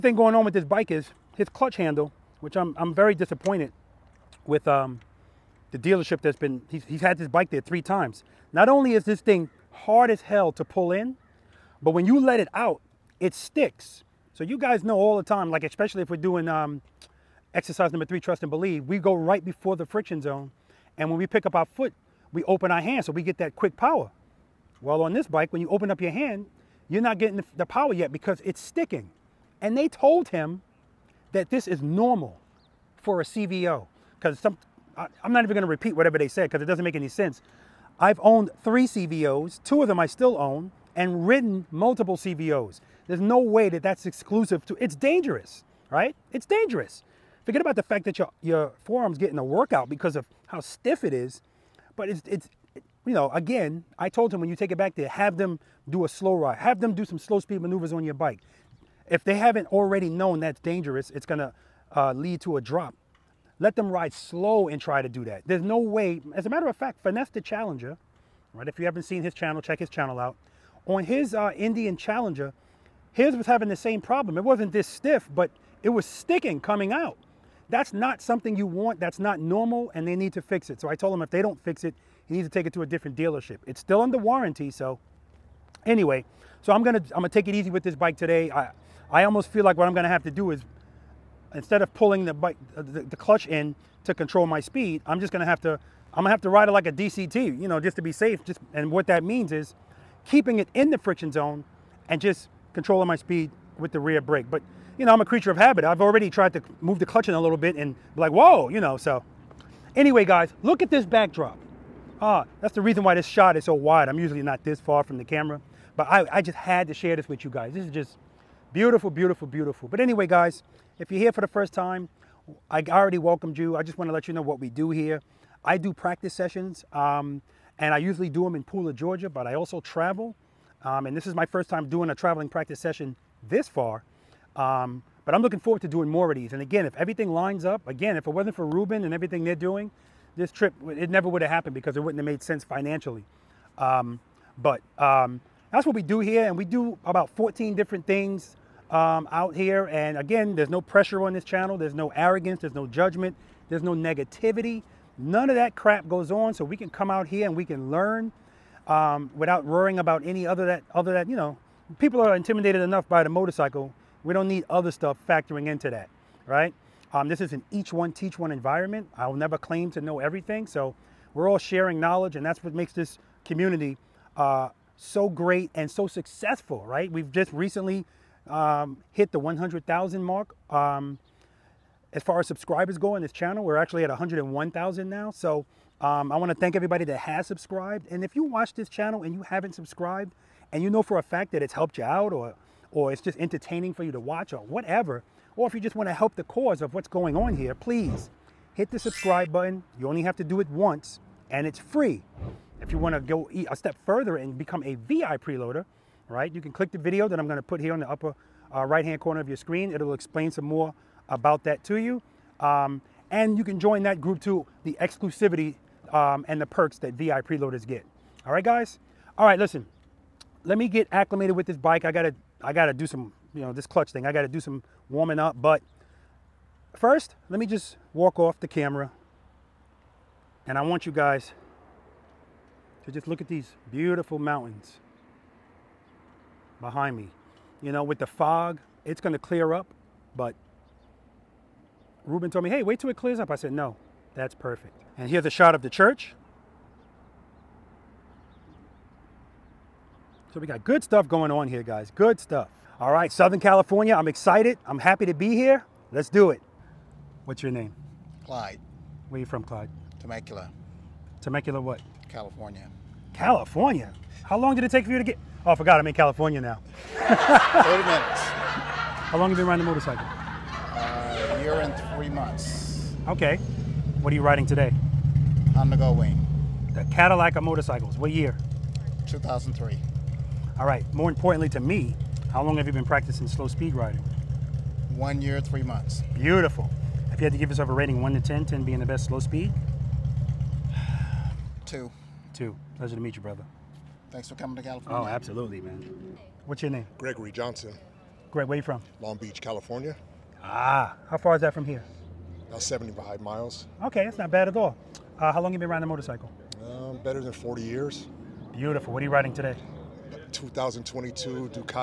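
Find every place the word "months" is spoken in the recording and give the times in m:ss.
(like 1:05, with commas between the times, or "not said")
4:32, 4:45.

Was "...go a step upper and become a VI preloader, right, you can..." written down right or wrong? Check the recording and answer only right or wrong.
wrong.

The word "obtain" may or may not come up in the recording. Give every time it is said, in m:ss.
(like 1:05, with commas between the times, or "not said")
not said.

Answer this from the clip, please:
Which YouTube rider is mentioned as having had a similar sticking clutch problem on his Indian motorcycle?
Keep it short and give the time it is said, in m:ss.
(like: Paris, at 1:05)
Finesse the Challenger, at 1:07.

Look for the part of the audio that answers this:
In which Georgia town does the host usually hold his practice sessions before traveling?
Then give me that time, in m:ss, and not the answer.
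2:08.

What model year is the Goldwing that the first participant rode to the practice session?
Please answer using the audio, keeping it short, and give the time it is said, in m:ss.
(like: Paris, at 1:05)
2003, at 4:39.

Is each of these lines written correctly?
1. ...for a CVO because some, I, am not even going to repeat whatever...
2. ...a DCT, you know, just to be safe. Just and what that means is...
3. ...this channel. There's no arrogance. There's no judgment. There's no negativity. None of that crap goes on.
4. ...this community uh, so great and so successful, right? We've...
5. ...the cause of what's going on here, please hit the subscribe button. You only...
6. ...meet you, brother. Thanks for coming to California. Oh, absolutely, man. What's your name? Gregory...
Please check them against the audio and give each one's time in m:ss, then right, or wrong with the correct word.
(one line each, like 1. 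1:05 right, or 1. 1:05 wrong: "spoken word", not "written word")
1. 0:33 right
2. 1:36 right
3. 2:31 right
4. 2:52 right
5. 3:16 right
6. 4:53 right.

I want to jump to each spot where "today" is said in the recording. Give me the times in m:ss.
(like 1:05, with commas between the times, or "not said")
1:28, 4:34, 5:09.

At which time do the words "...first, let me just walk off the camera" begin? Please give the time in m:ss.
3:46.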